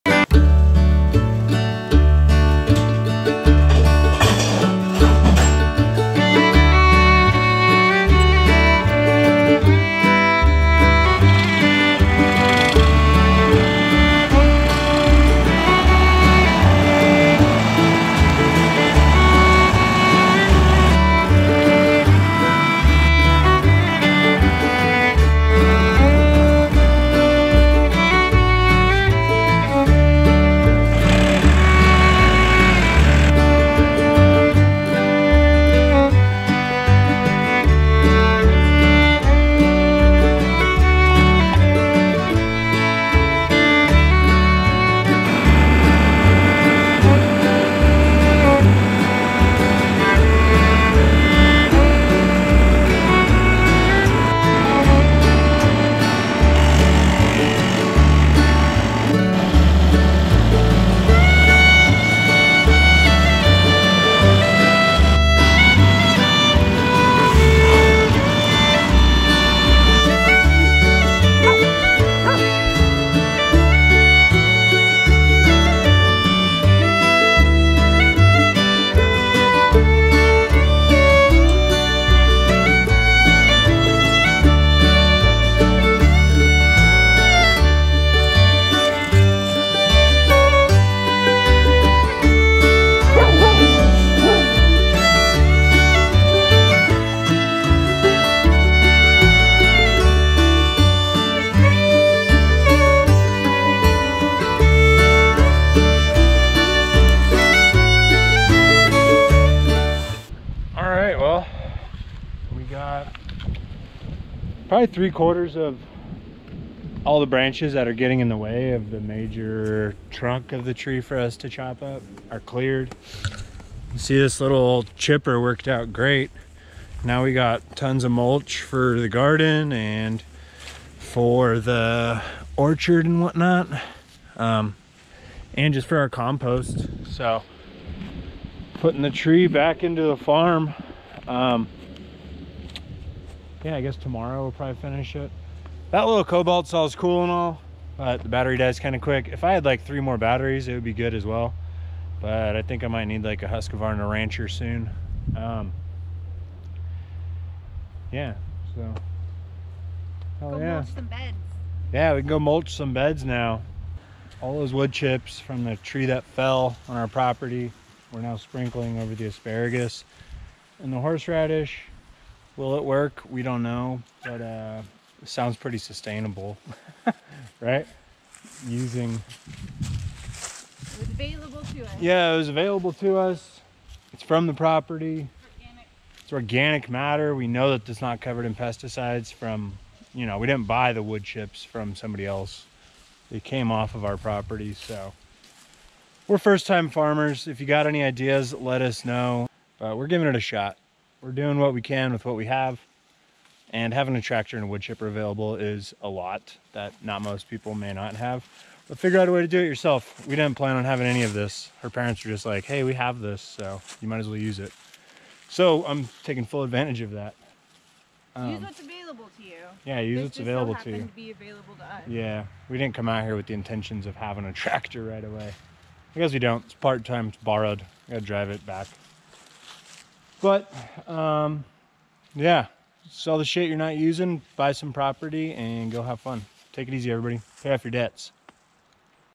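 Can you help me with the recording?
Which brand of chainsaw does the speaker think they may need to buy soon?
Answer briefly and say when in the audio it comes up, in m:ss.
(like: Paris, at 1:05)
Husqvarna, at 2:33.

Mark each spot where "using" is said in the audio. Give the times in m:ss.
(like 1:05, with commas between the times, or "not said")
2:58, 3:53.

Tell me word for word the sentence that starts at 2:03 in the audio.
You see this little chipper worked out great.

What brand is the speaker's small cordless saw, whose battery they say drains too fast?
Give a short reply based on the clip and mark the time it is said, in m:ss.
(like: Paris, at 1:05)
Kobalt, at 2:26.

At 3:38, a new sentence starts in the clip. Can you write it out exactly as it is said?
Um, use what's available to you.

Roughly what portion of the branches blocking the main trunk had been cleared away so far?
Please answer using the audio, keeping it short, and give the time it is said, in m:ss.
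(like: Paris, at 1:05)
Three quarters, at 1:54.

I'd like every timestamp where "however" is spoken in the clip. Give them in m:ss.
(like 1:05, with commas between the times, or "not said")
not said.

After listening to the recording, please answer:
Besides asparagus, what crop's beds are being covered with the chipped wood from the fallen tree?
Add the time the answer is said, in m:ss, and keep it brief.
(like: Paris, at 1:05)
Horseradish, at 2:50.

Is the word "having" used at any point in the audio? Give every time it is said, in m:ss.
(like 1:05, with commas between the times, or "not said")
3:23, 3:30, 3:44.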